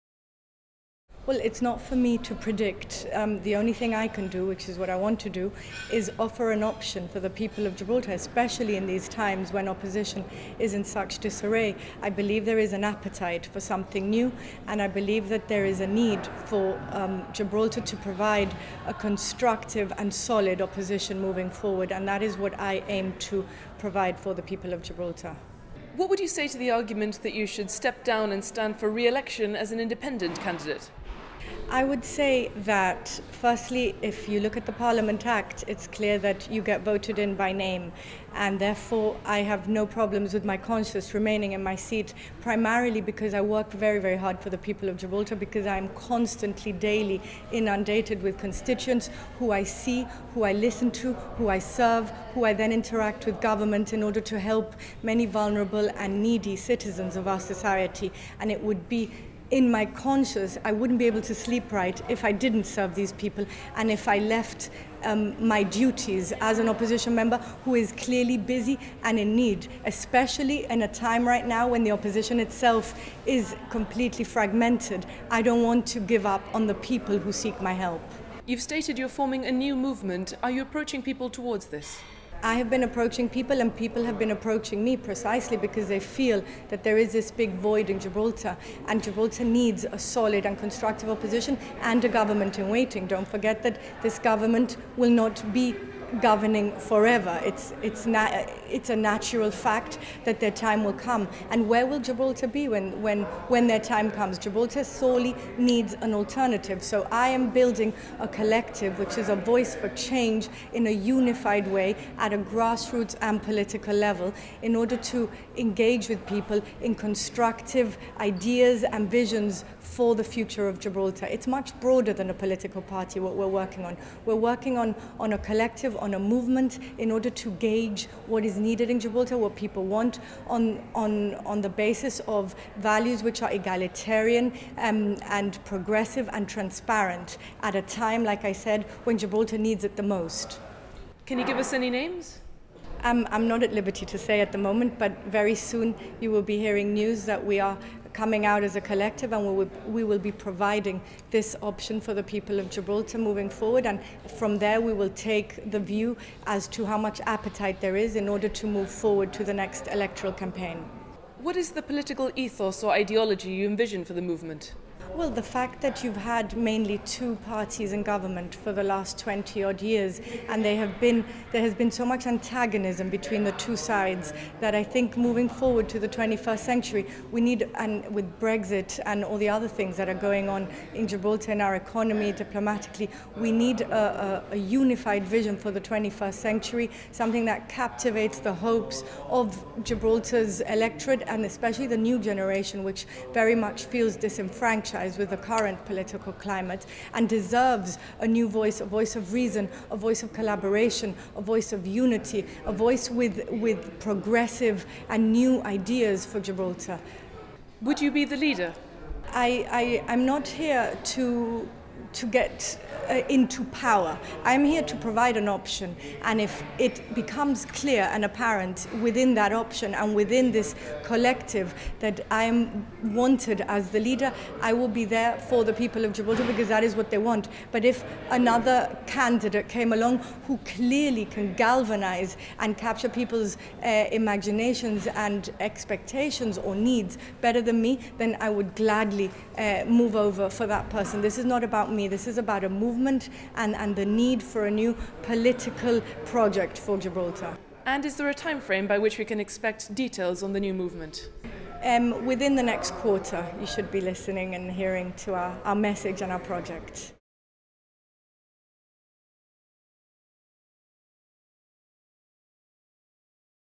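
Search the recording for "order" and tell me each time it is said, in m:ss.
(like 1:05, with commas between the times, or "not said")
0:54, 1:54, 2:07, 2:38.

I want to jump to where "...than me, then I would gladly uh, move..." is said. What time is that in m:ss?
3:57.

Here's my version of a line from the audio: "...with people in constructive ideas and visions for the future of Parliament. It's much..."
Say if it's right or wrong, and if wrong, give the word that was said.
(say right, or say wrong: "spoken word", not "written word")
wrong: "Gibraltar", not "Parliament".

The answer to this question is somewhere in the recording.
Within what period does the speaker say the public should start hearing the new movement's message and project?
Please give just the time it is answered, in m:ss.
4:12.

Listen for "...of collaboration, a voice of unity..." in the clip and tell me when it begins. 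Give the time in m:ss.
3:20.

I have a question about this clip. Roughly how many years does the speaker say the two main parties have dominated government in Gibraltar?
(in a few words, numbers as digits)
20 odd years.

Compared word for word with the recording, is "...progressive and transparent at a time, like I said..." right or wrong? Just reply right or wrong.
right.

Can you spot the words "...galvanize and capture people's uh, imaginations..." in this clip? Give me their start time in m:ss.
3:51.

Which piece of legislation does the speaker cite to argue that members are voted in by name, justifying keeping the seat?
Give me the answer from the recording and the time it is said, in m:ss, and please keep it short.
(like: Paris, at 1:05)
Parliament Act, at 0:34.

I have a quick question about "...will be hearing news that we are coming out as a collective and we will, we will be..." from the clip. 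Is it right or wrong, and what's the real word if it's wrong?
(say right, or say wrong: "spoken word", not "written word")
right.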